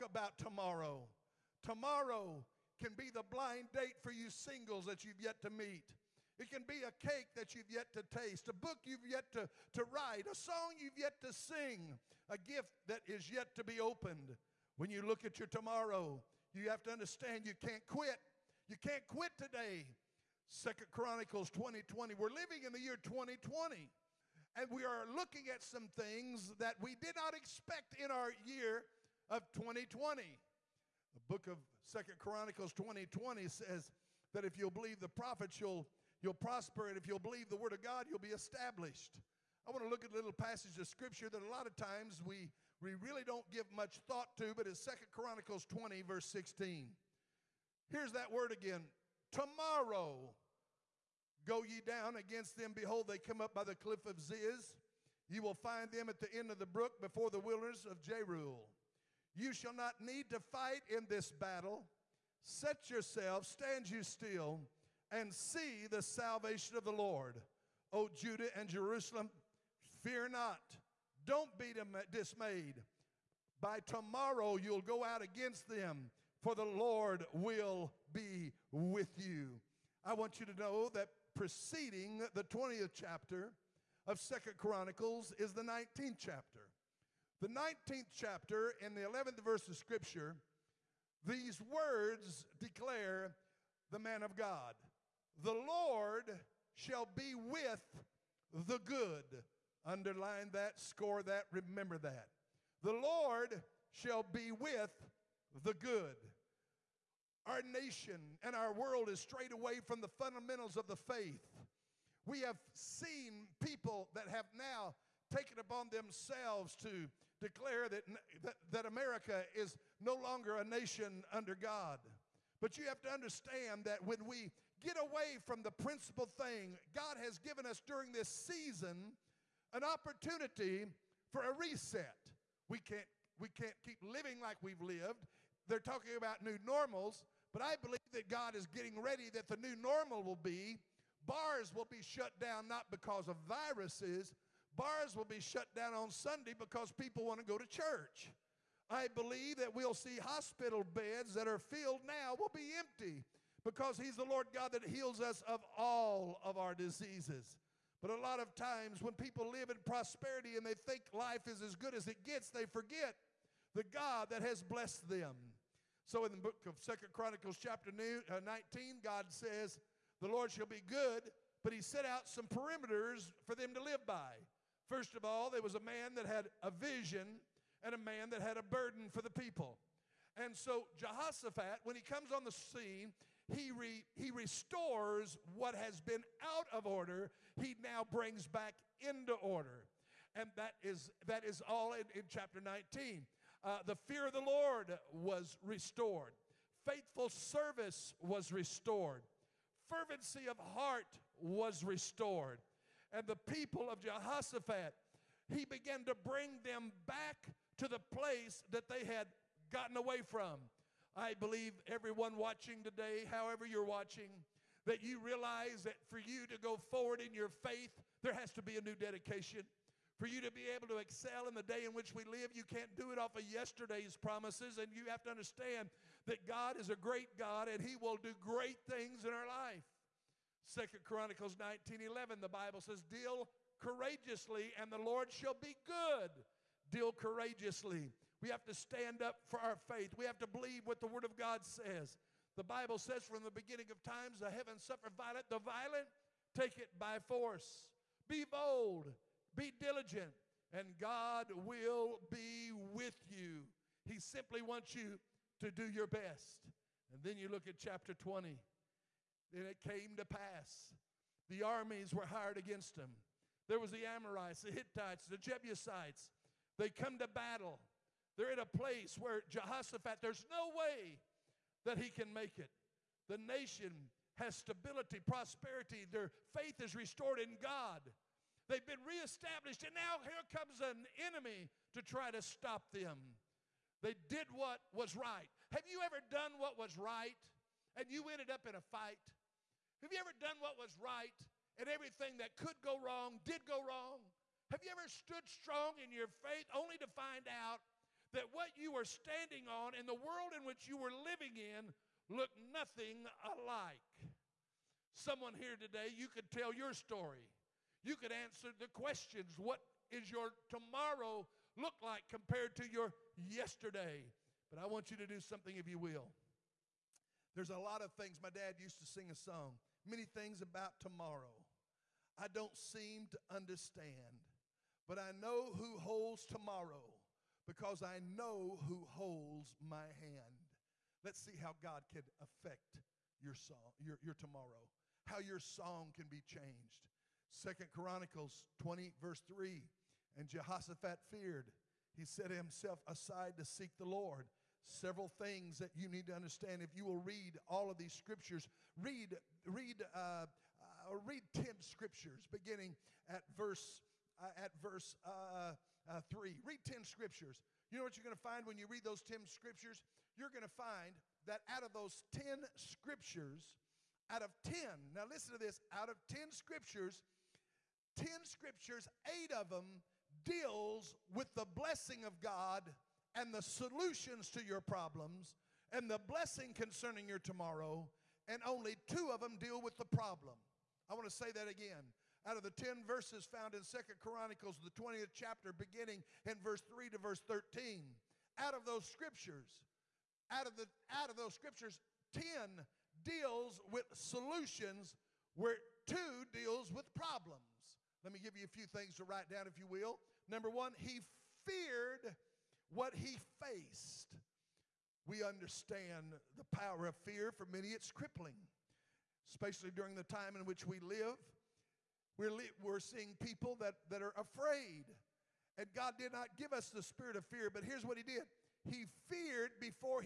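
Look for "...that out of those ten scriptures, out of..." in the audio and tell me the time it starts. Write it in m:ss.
6:01.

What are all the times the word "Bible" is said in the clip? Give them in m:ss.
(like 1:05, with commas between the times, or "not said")
3:52, 4:02.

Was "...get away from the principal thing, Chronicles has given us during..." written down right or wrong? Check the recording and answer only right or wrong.
wrong.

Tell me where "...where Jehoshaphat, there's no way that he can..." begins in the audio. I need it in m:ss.
4:29.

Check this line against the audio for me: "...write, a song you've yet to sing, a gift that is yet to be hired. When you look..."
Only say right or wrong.
wrong.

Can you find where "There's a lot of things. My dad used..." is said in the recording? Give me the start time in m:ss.
5:17.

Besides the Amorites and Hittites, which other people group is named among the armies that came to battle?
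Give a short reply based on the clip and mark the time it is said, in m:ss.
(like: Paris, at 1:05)
Jebusites, at 4:25.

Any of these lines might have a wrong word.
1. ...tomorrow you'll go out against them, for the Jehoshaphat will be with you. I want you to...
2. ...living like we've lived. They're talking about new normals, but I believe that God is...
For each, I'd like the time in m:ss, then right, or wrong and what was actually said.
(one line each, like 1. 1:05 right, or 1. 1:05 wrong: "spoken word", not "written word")
1. 1:13 wrong: "Lord", not "Jehoshaphat"
2. 2:14 right.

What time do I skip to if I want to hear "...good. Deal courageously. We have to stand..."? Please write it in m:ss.
3:55.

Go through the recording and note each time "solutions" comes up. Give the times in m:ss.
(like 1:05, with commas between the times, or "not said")
6:13, 6:34.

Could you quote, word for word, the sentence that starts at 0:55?
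You will find them at the end of the brook before the wilderness of Jeruel.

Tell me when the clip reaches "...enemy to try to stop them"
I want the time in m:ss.
4:41.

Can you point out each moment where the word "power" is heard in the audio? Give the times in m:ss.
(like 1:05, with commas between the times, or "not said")
6:46.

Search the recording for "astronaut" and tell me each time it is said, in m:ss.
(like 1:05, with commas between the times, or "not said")
not said.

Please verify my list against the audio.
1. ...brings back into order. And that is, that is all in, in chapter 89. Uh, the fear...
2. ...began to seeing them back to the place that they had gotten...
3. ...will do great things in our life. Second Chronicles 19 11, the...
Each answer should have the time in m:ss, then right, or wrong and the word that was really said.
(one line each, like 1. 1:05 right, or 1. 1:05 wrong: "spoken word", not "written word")
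1. 3:08 wrong: "19", not "89"
2. 3:25 wrong: "bring", not "seeing"
3. 3:47 right.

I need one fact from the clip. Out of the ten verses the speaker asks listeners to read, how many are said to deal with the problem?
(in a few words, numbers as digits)
2.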